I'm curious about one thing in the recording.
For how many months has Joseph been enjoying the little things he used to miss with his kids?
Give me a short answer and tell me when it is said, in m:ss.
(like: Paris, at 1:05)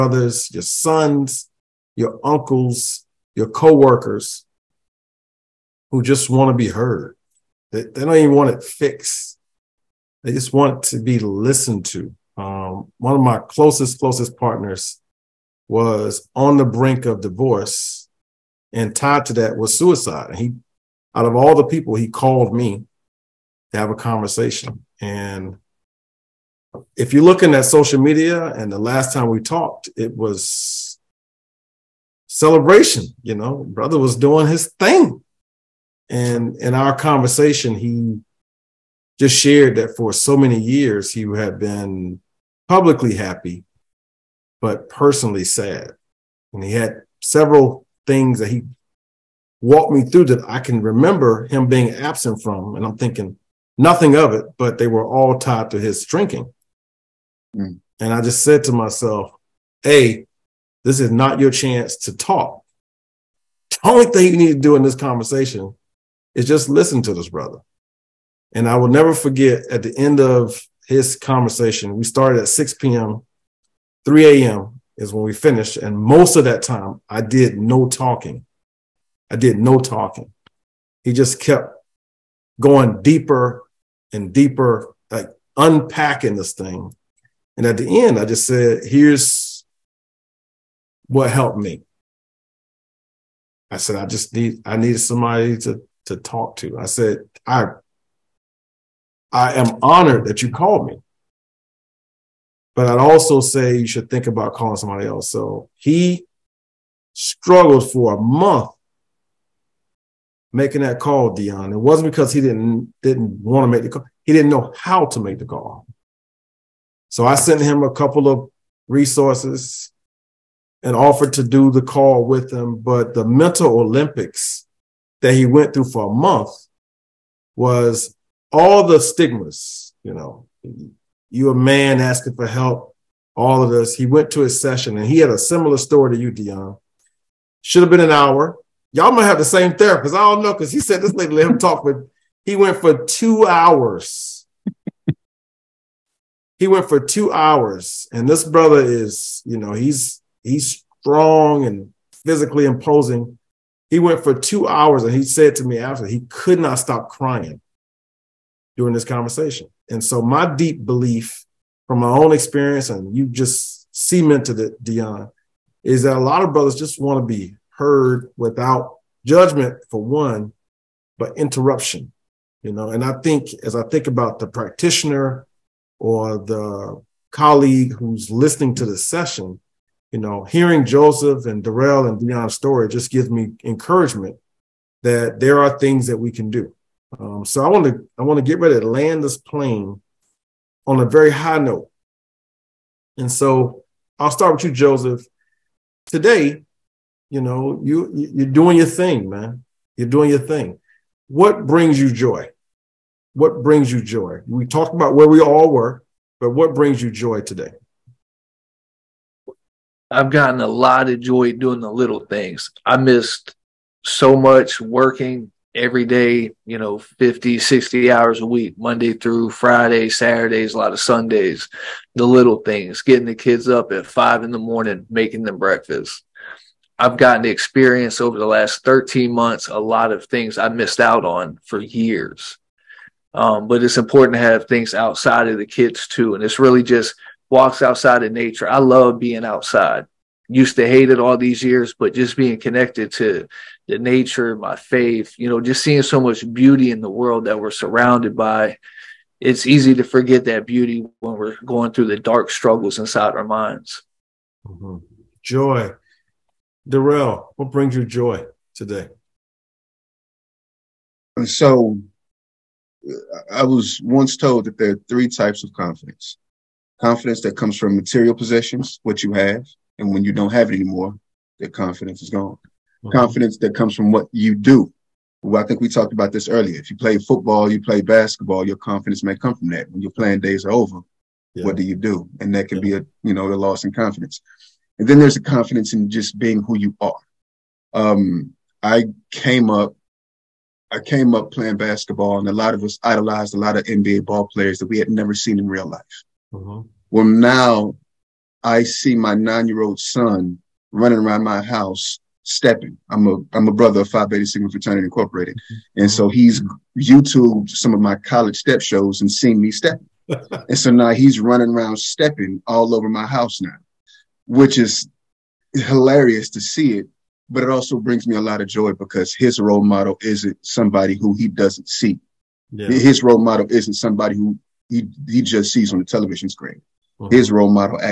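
13 months, at 3:48.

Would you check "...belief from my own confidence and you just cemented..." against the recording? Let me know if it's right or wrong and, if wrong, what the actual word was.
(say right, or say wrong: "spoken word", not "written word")
wrong: "experience", not "confidence".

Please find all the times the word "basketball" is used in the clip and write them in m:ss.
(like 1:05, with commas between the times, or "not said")
4:38, 4:51.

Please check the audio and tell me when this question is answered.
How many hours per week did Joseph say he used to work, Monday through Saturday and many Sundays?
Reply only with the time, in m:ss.
3:36.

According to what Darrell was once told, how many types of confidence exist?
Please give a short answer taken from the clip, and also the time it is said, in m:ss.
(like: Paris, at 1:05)
3, at 4:25.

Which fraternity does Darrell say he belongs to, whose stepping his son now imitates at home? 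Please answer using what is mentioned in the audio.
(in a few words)
Phi Beta Sigma.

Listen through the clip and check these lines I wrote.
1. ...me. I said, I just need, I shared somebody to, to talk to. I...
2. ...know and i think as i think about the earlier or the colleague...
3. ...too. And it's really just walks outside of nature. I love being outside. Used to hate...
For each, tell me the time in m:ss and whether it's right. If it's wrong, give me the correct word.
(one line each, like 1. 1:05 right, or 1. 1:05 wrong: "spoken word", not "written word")
1. 1:31 wrong: "needed", not "shared"
2. 2:52 wrong: "practitioner", not "earlier"
3. 3:56 right.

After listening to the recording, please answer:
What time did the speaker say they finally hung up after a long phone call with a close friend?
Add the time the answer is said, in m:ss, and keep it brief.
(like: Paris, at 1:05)
3 a.m., at 1:14.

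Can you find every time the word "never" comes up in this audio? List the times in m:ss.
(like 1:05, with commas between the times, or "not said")
1:08, 4:55.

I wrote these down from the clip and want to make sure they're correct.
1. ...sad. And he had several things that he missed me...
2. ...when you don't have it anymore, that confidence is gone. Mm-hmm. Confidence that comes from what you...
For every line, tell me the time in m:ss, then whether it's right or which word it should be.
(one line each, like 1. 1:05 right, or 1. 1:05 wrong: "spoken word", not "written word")
1. 0:45 wrong: "walked", not "missed"
2. 4:30 right.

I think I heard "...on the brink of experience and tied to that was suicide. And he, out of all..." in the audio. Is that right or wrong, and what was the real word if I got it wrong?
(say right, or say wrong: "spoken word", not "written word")
wrong: "divorce", not "experience".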